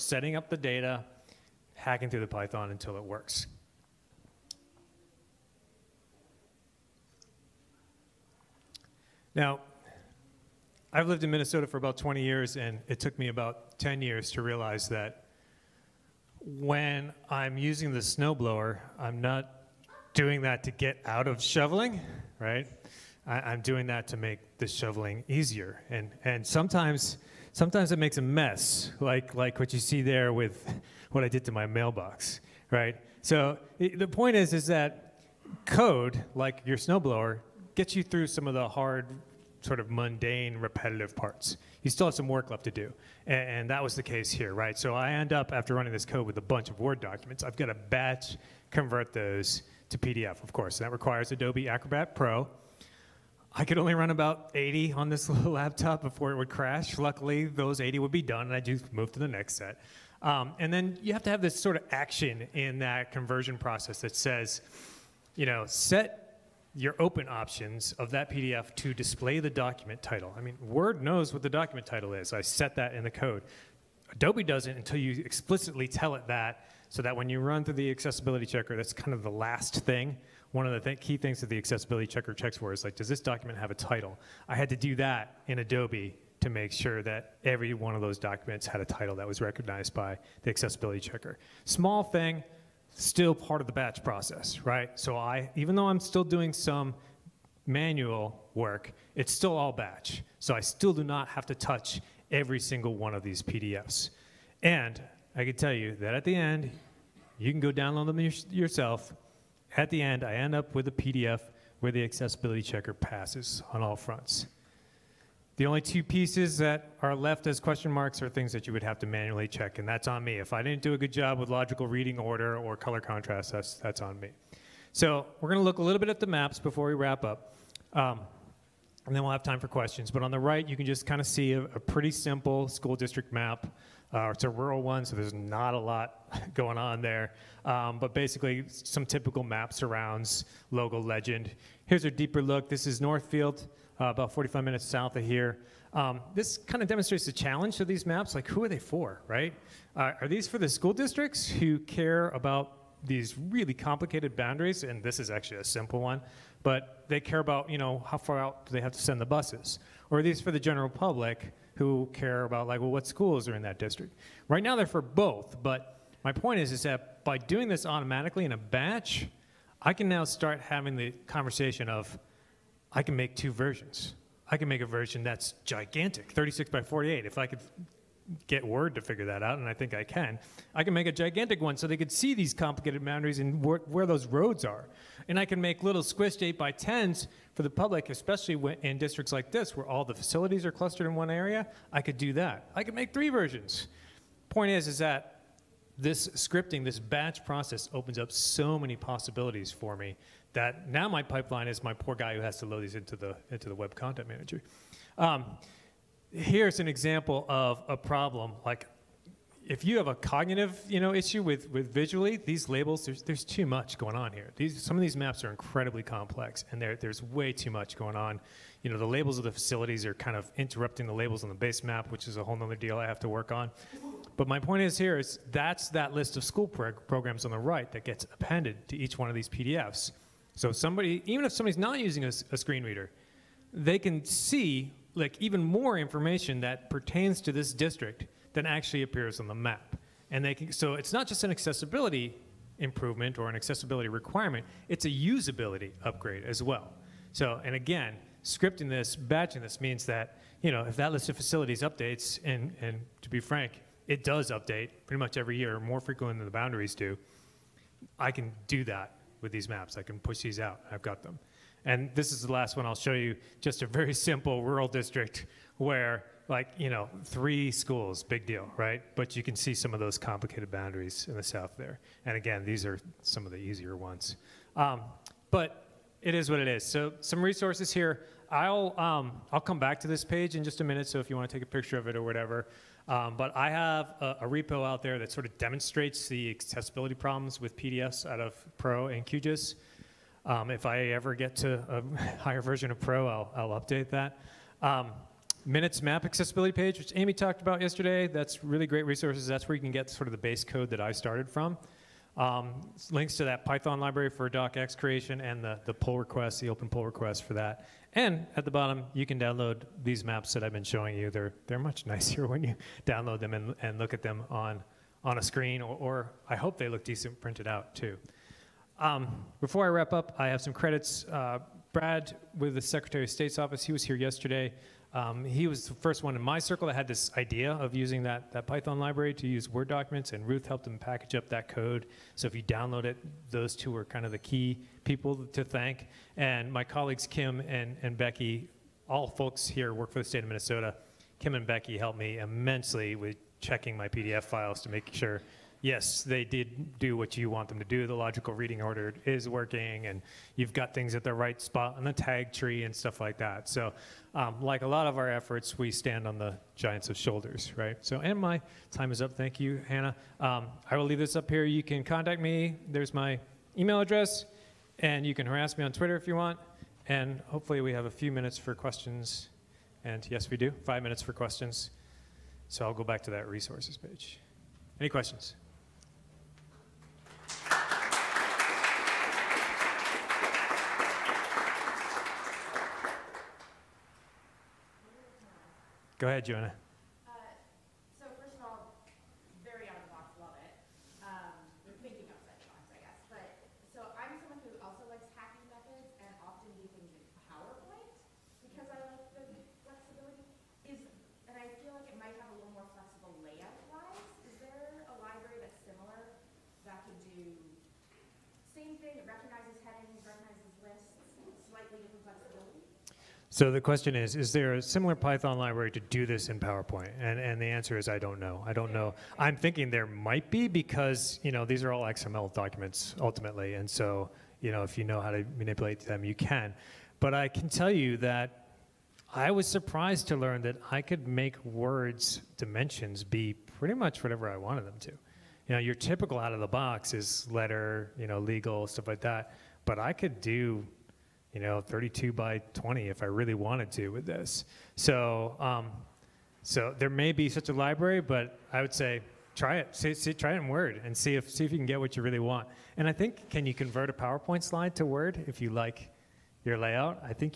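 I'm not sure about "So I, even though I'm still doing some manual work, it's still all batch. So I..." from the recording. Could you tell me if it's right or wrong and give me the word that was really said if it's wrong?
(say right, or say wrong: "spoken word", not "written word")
right.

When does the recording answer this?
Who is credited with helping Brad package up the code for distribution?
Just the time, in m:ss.
5:30.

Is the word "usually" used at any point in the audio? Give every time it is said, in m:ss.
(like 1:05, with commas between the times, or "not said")
not said.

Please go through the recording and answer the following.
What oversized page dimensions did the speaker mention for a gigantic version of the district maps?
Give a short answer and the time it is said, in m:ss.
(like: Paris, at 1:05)
36 by 48, at 2:56.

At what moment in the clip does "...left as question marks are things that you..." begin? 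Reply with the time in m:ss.
1:57.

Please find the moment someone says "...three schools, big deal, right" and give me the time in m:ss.
4:27.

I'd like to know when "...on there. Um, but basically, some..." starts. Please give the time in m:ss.
2:16.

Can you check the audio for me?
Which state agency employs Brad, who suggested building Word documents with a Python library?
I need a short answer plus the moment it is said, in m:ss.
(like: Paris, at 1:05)
Secretary of State's office, at 5:22.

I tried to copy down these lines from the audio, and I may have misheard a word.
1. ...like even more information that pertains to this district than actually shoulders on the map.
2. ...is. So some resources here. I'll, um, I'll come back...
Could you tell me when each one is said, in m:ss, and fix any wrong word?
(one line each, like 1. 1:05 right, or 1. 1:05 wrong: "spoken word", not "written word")
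1. 3:55 wrong: "appears", not "shoulders"
2. 4:36 right.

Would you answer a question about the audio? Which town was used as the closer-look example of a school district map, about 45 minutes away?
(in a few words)
Northfield.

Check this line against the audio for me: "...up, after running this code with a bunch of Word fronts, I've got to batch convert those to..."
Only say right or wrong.
wrong.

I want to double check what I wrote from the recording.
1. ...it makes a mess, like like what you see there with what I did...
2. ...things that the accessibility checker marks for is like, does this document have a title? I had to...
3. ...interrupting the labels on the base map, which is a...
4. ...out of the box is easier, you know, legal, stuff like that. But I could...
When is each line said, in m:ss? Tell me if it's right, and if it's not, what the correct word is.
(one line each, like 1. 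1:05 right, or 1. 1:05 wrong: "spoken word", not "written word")
1. 0:27 right
2. 1:21 wrong: "checks", not "marks"
3. 3:40 right
4. 7:16 wrong: "letter", not "easier".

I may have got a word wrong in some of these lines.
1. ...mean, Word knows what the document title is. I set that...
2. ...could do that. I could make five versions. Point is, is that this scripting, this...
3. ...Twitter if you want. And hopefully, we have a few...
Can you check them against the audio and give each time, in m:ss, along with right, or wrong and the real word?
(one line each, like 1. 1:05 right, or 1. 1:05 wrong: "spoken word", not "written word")
1. 1:10 right
2. 3:11 wrong: "three", not "five"
3. 6:05 right.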